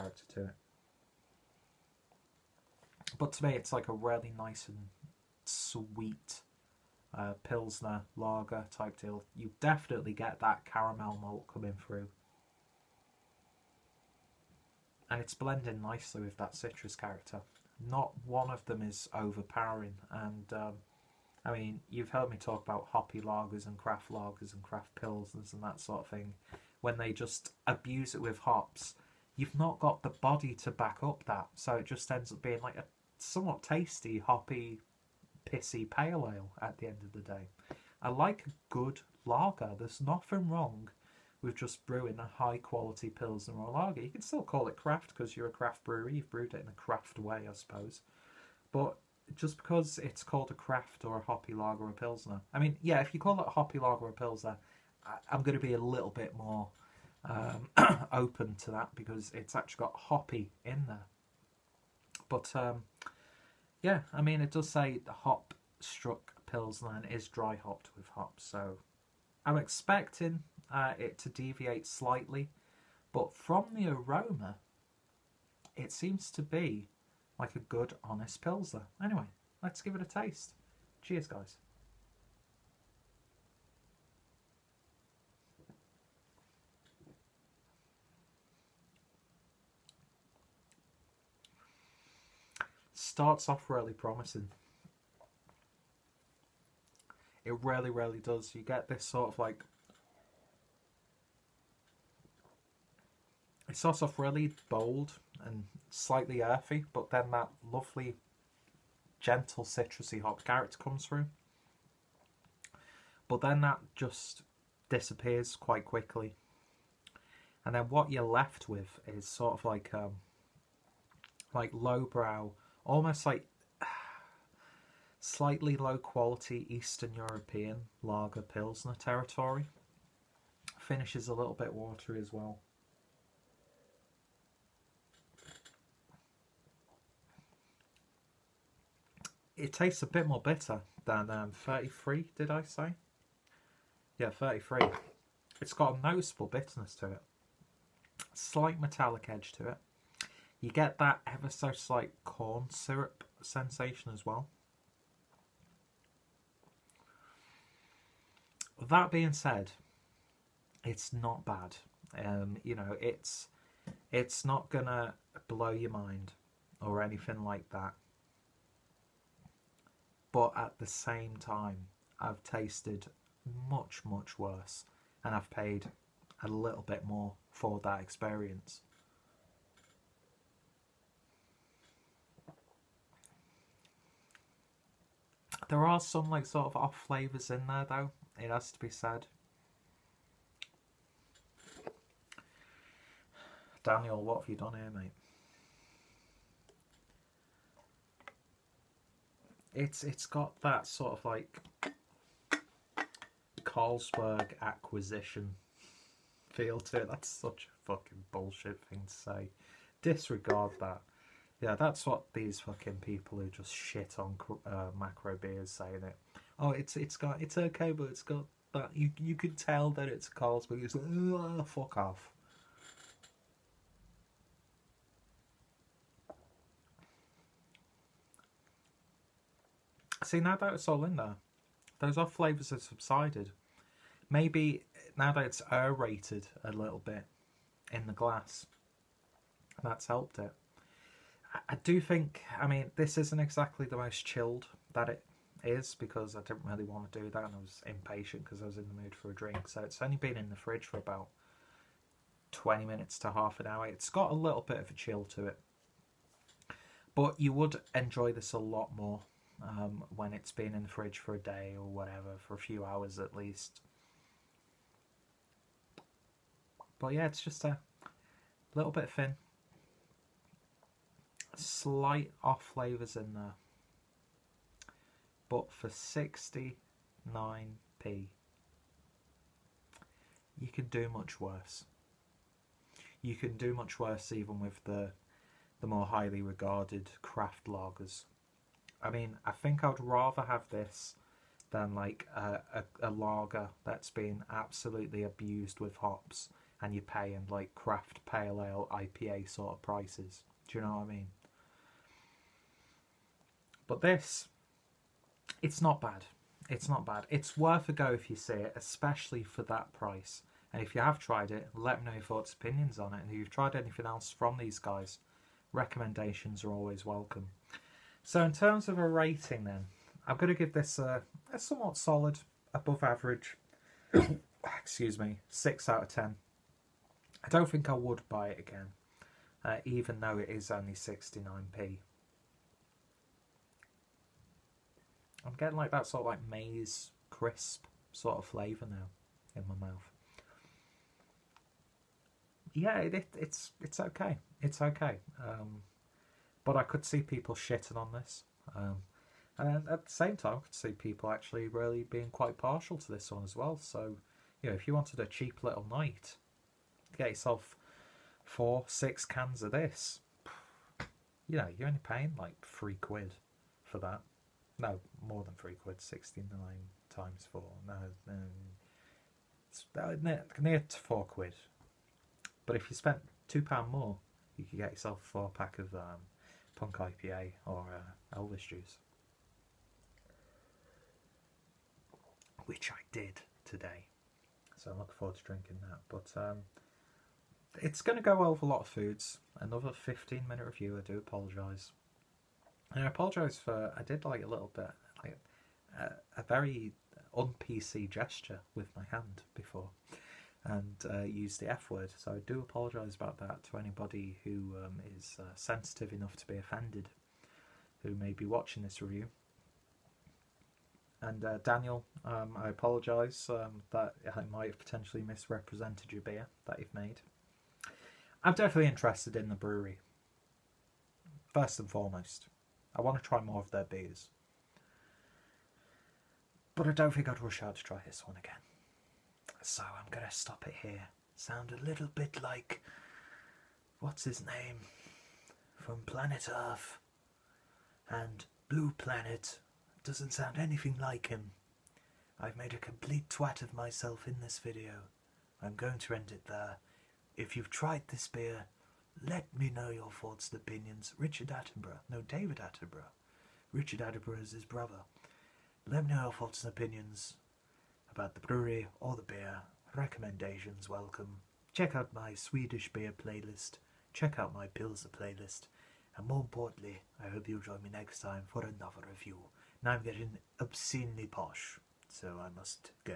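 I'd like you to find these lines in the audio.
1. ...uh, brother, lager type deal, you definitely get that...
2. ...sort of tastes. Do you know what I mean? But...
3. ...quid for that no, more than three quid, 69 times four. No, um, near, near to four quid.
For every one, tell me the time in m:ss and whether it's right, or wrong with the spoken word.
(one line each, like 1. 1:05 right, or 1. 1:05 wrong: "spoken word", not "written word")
1. 0:07 wrong: "pilsner", not "brother"
2. 4:59 wrong: "prices", not "tastes"
3. 6:02 right.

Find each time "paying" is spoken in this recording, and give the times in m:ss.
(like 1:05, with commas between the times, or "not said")
4:57, 6:02.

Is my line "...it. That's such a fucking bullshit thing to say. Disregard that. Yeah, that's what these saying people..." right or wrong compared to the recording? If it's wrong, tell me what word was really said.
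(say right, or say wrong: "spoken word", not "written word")
wrong: "fucking", not "saying".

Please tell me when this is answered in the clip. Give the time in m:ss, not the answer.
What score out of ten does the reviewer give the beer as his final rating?
5:25.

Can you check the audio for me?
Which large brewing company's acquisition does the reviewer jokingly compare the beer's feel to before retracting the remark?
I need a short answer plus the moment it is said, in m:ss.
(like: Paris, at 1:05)
Carlsberg, at 3:23.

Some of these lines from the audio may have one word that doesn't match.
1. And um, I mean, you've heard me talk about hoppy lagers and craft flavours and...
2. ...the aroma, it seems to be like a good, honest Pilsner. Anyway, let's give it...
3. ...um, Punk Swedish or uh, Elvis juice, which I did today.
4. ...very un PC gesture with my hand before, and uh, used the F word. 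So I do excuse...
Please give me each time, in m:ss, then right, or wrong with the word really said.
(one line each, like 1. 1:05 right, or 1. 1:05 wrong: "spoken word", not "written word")
1. 0:20 wrong: "lagers", not "flavours"
2. 1:13 right
3. 6:15 wrong: "IPA", not "Swedish"
4. 6:36 wrong: "apologise", not "excuse".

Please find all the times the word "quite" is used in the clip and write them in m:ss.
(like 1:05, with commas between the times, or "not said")
1:55, 5:52.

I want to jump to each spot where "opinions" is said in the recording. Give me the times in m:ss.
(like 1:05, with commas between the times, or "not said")
5:12, 7:30, 7:36.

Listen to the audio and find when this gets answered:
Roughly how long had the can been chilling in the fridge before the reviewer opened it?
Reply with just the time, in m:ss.
4:12.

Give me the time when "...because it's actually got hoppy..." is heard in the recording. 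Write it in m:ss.
0:58.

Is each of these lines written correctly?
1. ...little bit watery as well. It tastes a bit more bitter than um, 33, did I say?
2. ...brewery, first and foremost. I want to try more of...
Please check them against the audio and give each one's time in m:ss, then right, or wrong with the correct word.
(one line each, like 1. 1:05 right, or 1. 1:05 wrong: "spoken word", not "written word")
1. 2:11 right
2. 6:59 right.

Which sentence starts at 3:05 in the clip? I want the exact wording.
There are some like sort of off flavours in there though, it has to be said.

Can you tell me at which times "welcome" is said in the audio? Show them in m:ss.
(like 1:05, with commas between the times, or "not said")
5:17, 7:40.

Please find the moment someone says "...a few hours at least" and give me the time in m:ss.
4:22.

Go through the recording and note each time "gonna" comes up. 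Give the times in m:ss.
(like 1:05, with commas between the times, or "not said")
2:44.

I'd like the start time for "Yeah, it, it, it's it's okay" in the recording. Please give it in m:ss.
5:42.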